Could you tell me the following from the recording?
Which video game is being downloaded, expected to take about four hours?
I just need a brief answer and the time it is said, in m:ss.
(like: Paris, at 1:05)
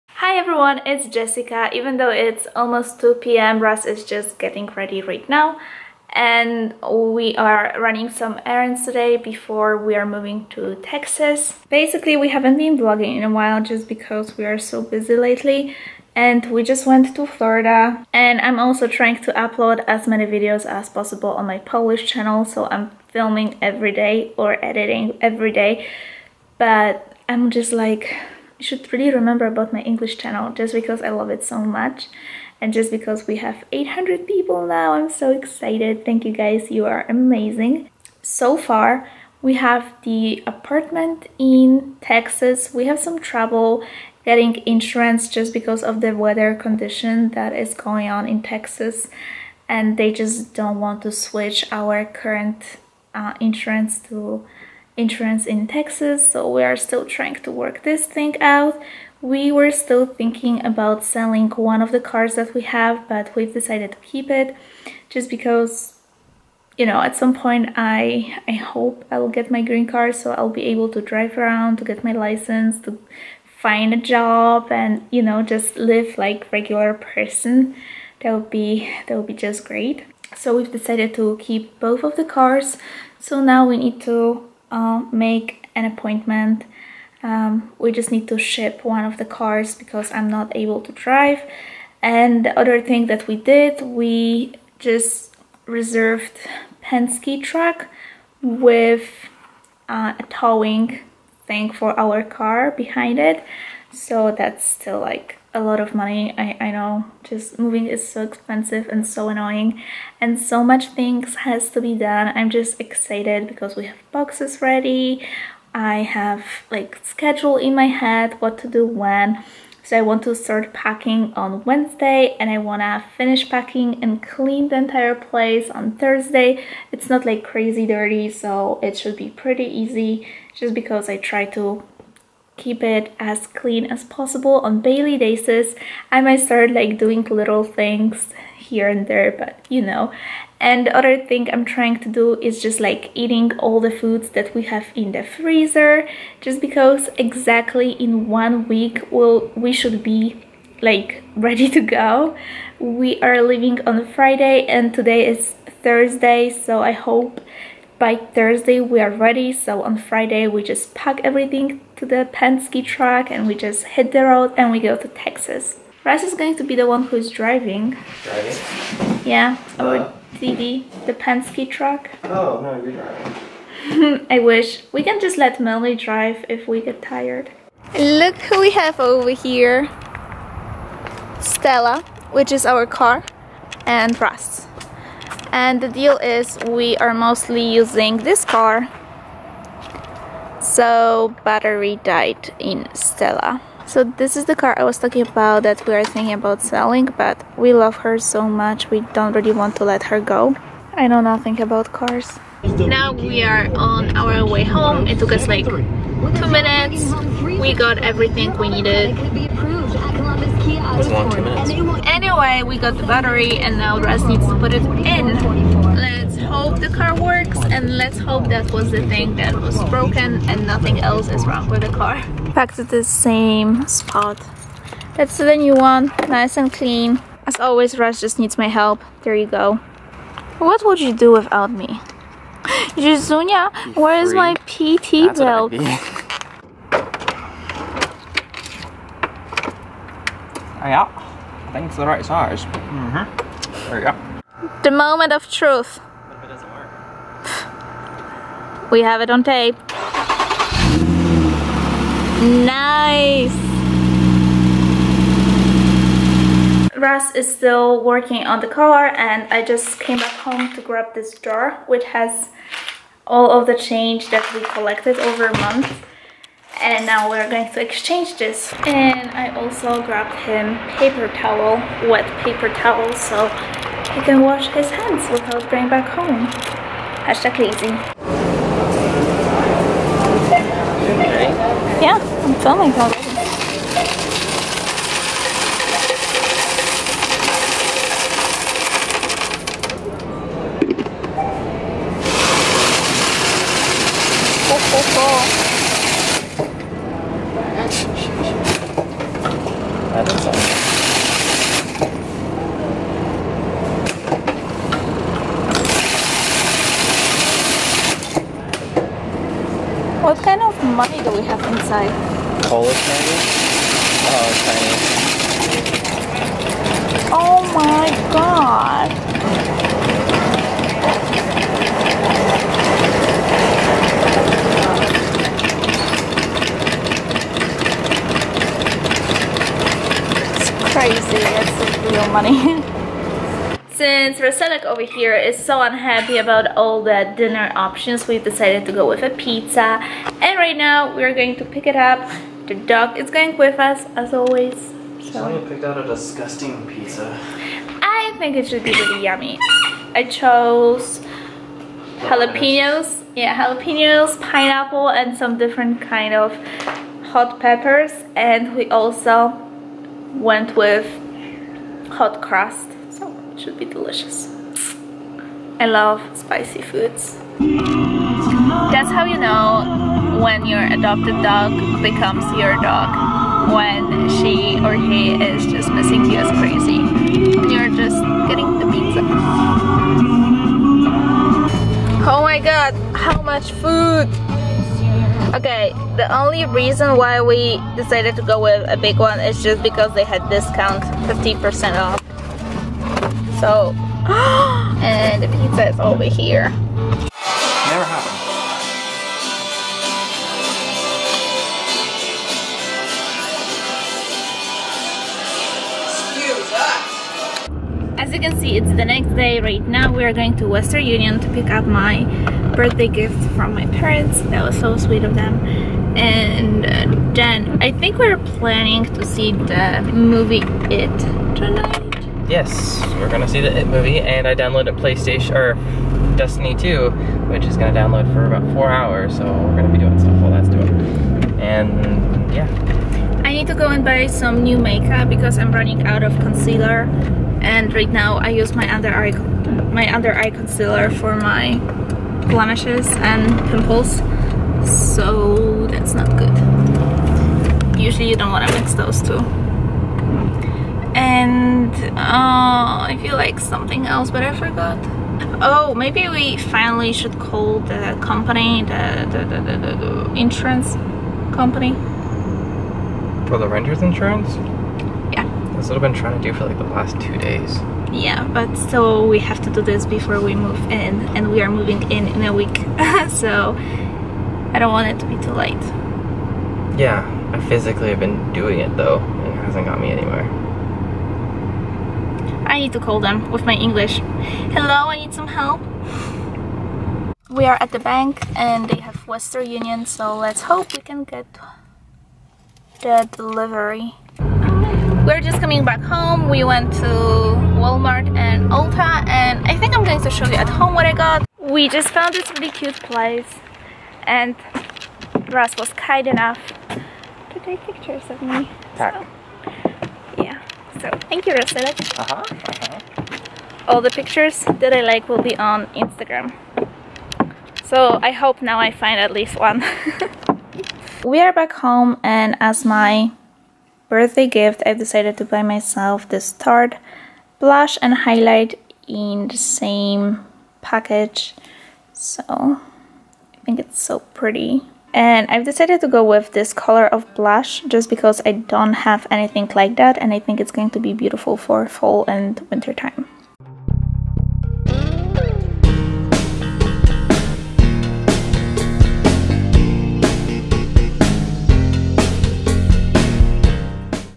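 Destiny 2, at 7:06.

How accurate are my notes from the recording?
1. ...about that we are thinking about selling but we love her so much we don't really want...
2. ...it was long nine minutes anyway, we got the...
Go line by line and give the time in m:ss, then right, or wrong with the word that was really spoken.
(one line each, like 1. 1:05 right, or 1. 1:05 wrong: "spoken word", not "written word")
1. 3:15 right
2. 3:29 wrong: "two", not "nine".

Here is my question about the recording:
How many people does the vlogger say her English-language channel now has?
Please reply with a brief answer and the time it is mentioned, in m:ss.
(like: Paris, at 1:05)
800, at 0:33.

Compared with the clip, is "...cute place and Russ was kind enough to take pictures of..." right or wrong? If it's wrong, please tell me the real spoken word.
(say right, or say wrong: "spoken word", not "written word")
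right.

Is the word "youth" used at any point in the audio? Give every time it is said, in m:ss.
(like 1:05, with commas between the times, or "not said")
not said.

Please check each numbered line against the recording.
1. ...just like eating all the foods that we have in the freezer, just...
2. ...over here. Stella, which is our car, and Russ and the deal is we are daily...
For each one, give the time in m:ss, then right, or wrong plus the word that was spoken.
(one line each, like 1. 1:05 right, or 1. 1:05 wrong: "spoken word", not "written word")
1. 2:22 right
2. 2:58 wrong: "mostly", not "daily".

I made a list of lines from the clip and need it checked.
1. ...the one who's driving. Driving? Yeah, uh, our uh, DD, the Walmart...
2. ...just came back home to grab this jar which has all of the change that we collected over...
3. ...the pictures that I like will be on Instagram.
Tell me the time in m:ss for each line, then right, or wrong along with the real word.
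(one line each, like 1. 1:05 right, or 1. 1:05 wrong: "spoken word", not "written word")
1. 2:46 wrong: "Penske", not "Walmart"
2. 4:19 right
3. 8:34 right.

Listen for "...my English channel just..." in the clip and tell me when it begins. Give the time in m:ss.
0:29.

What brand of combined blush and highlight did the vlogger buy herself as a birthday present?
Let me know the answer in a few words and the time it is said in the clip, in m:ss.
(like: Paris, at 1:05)
Tarte, at 8:46.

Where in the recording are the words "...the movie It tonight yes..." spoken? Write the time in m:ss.
6:59.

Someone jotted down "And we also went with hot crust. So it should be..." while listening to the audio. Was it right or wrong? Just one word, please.
right.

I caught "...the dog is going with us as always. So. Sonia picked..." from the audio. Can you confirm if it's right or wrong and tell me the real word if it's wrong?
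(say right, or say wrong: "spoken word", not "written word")
right.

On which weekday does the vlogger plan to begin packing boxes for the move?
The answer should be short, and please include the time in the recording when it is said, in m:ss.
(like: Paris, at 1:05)
Wednesday, at 2:01.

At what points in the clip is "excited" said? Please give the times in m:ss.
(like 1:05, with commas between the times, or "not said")
0:35, 1:52.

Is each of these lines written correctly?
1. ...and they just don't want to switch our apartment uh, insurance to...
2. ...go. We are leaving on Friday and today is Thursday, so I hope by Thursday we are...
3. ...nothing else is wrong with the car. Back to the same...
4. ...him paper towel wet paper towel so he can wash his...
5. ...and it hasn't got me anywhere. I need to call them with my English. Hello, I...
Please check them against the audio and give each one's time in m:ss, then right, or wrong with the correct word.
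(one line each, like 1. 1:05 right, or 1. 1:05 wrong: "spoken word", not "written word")
1. 0:49 wrong: "current", not "apartment"
2. 2:31 right
3. 3:40 right
4. 4:30 right
5. 7:59 right.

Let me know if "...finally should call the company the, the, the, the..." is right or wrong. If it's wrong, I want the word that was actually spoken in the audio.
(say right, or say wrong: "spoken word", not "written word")
right.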